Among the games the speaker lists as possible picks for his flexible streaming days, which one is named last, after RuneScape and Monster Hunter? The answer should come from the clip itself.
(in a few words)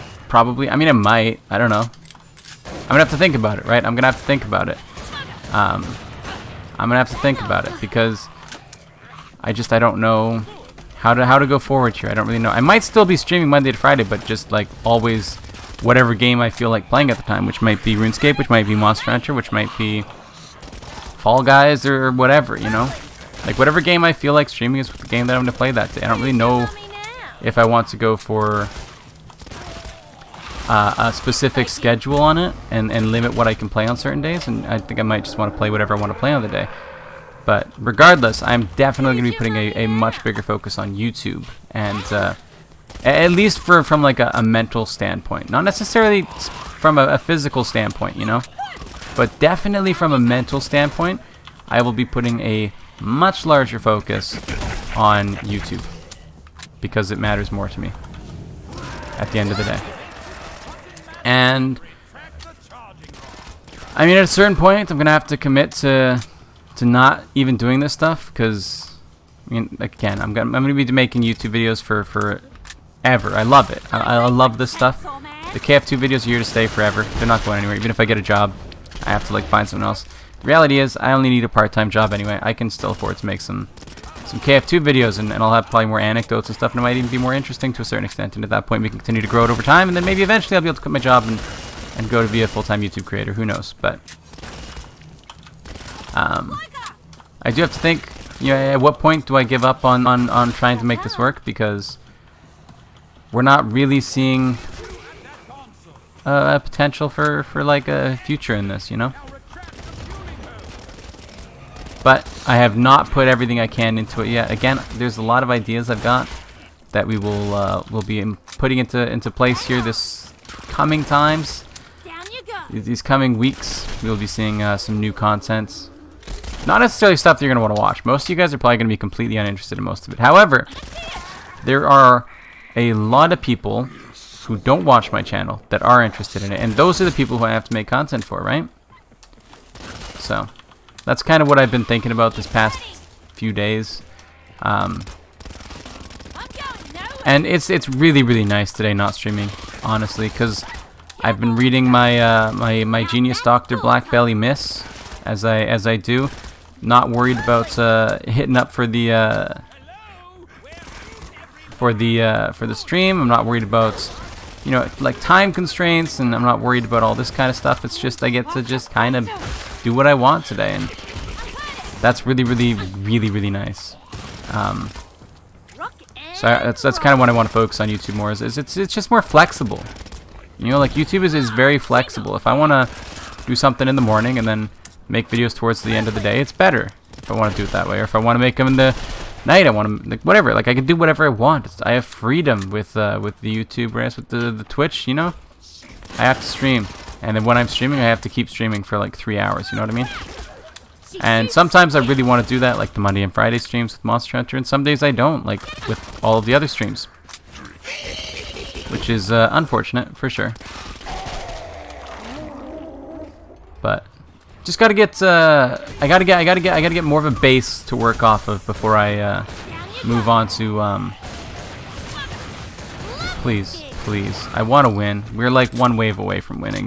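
Fall Guys.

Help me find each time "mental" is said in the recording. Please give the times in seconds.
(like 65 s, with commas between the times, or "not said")
44 s, 50 s.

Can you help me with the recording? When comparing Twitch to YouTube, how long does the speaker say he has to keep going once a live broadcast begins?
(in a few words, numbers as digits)
3 hours.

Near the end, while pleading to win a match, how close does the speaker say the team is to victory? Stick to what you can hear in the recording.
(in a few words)
1 wave away.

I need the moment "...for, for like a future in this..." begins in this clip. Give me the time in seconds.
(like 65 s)
107 s.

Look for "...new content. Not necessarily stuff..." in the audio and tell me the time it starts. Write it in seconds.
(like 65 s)
125 s.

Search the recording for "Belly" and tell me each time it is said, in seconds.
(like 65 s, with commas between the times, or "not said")
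154 s.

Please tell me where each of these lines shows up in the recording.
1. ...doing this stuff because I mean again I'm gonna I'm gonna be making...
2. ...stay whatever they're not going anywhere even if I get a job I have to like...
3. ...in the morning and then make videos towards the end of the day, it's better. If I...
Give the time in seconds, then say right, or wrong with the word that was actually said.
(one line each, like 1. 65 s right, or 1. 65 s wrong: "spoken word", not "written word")
1. 67 s right
2. 76 s wrong: "forever", not "whatever"
3. 183 s right.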